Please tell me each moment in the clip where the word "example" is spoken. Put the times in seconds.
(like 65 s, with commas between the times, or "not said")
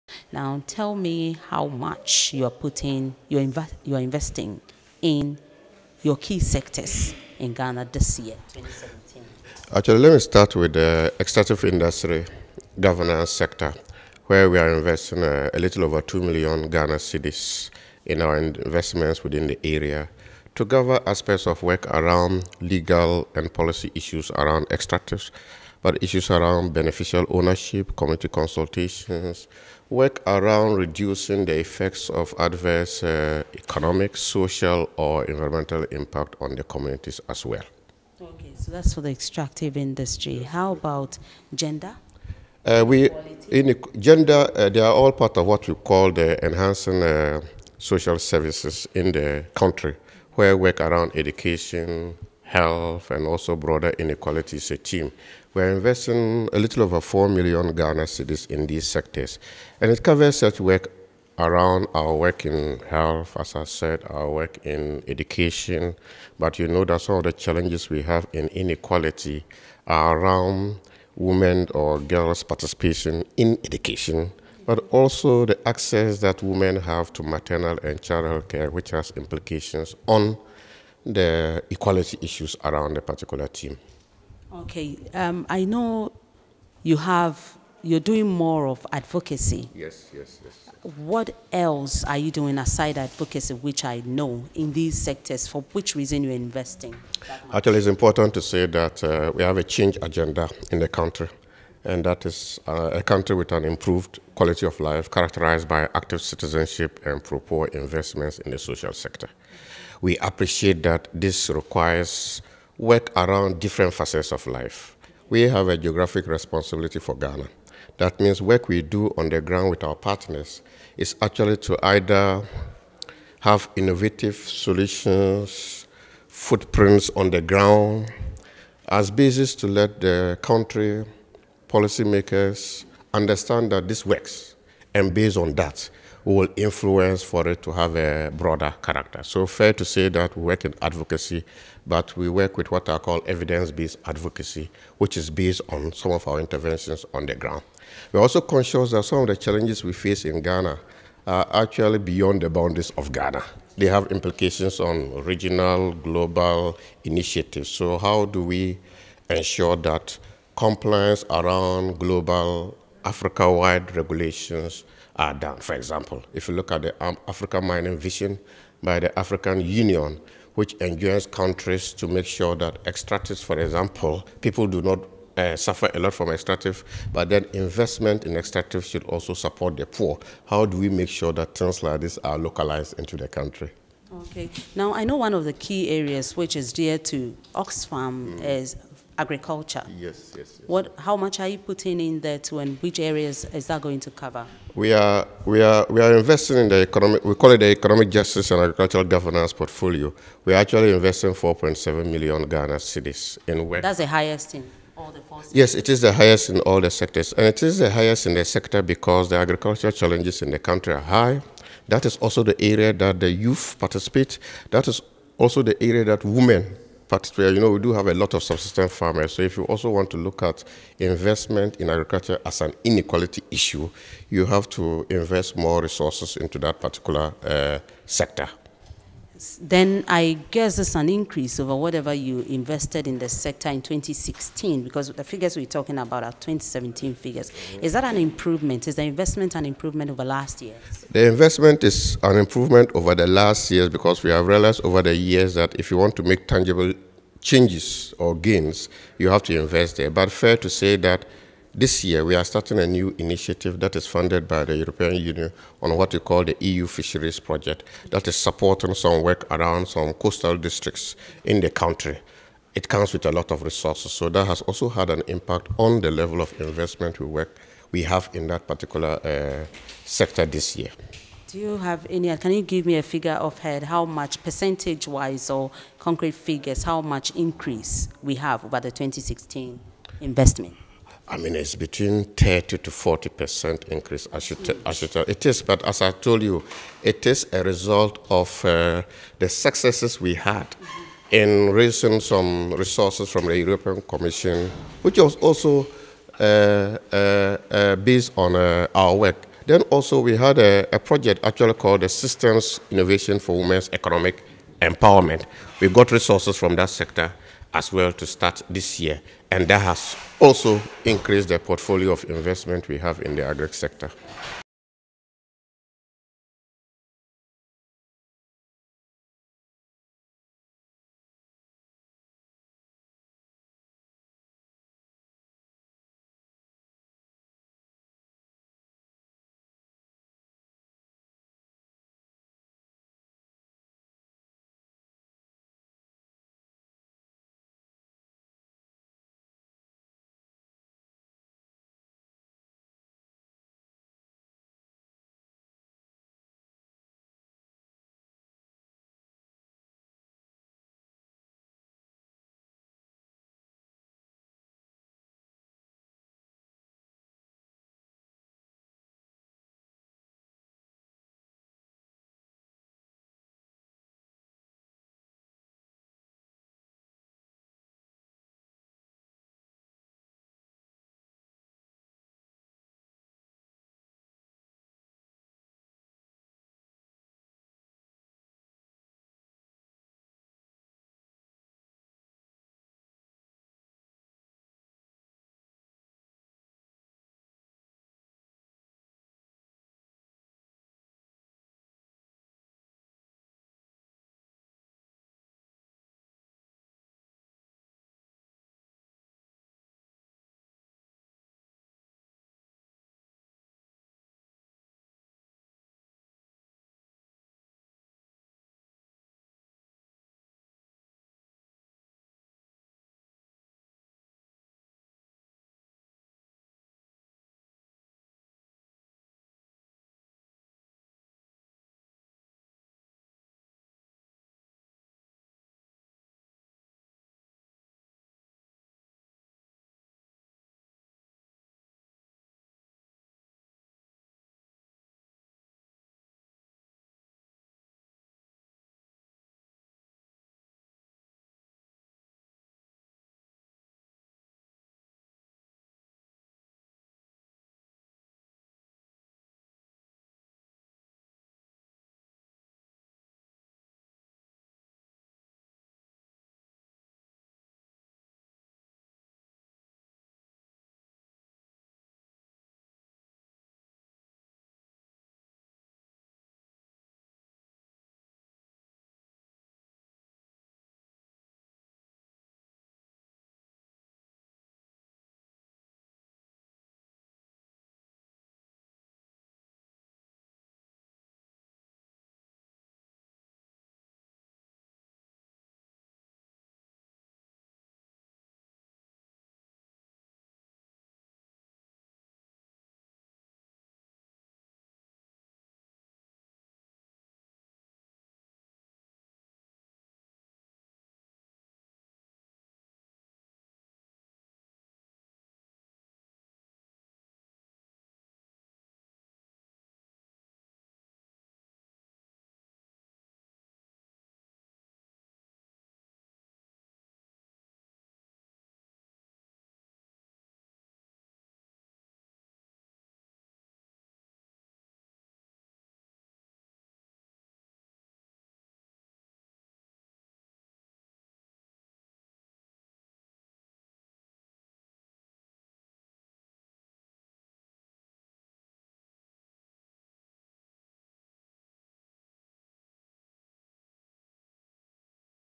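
165 s, 173 s.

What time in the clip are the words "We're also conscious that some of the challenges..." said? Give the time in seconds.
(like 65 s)
148 s.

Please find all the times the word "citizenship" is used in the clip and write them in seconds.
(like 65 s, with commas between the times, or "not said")
106 s.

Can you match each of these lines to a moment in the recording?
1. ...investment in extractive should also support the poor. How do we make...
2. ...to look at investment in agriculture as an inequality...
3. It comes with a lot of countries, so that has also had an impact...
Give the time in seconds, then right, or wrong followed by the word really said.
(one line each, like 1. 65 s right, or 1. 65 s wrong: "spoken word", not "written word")
1. 177 s right
2. 220 s right
3. 262 s wrong: "resources", not "countries".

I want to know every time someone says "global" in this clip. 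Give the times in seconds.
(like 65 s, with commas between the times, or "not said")
155 s, 161 s.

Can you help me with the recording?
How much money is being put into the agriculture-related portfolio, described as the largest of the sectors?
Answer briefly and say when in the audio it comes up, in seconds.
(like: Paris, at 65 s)
4.7 million Ghana cedis, at 201 s.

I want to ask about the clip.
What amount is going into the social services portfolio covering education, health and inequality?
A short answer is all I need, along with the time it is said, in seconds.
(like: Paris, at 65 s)
A little over 4 million Ghana cedis, at 56 s.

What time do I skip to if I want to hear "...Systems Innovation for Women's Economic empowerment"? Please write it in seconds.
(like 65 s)
302 s.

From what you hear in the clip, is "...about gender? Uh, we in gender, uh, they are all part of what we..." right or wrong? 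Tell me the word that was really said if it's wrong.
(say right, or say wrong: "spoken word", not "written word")
right.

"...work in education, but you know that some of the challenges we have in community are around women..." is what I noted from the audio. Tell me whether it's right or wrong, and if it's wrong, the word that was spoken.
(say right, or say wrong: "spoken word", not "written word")
wrong: "inequality", not "community".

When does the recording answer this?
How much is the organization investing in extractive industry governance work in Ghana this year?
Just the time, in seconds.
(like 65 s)
15 s.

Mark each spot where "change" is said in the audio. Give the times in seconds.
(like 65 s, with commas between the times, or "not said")
99 s, 247 s.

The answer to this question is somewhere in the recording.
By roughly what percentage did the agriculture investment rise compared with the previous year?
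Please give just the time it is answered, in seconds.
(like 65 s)
282 s.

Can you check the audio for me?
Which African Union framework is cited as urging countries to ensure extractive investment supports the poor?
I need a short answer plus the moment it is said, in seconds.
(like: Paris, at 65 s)
African Mining Vision, at 167 s.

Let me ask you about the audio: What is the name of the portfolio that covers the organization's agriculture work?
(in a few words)
Economic Justice and Agricultural Governance.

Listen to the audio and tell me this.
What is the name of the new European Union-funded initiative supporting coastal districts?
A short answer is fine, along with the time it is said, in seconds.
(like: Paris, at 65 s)
EU Fisheries Project, at 256 s.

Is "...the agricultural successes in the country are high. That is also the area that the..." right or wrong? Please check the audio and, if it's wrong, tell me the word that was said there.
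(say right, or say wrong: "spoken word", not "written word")
wrong: "challenges", not "successes".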